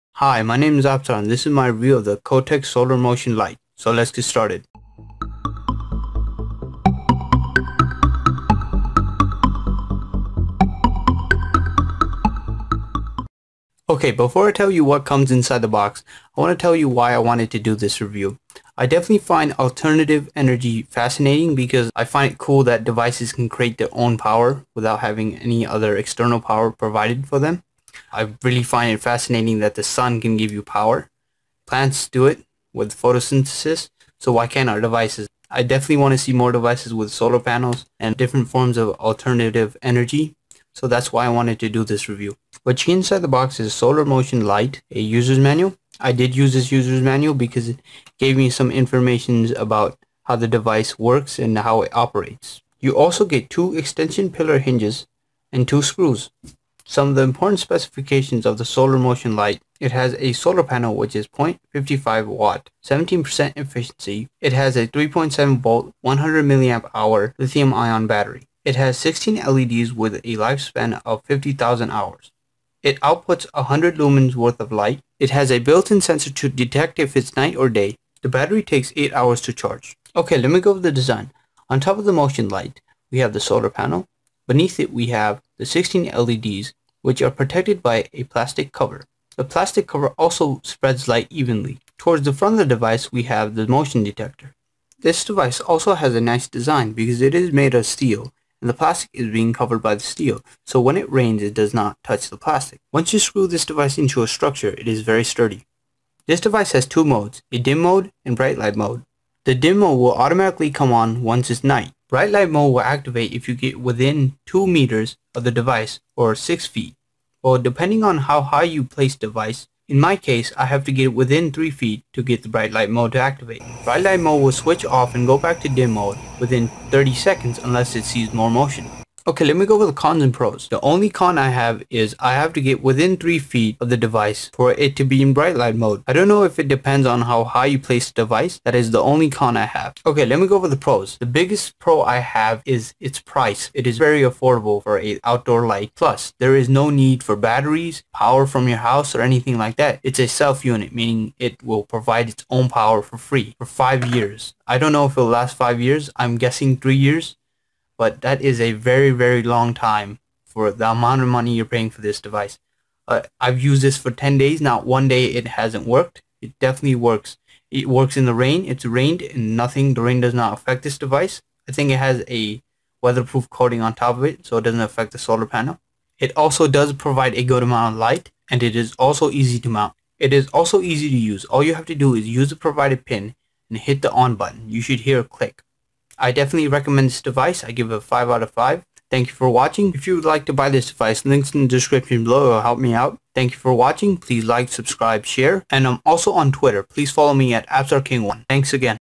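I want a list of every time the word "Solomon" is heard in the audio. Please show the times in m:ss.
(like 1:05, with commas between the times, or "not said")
not said.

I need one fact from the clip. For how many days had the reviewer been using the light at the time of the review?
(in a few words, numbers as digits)
10 days.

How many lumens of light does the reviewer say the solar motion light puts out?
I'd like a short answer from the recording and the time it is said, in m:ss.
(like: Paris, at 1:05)
100 lumens, at 1:13.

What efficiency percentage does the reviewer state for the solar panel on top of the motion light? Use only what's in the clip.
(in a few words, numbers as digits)
17%.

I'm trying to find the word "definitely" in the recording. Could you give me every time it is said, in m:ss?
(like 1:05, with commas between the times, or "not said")
0:18, 0:35, 2:46, 3:06.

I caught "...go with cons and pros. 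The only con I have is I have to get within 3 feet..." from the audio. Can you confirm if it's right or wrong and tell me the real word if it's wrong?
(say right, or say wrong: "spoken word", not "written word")
right.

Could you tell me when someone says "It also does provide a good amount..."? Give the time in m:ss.
2:56.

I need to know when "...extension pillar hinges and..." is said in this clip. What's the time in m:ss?
0:53.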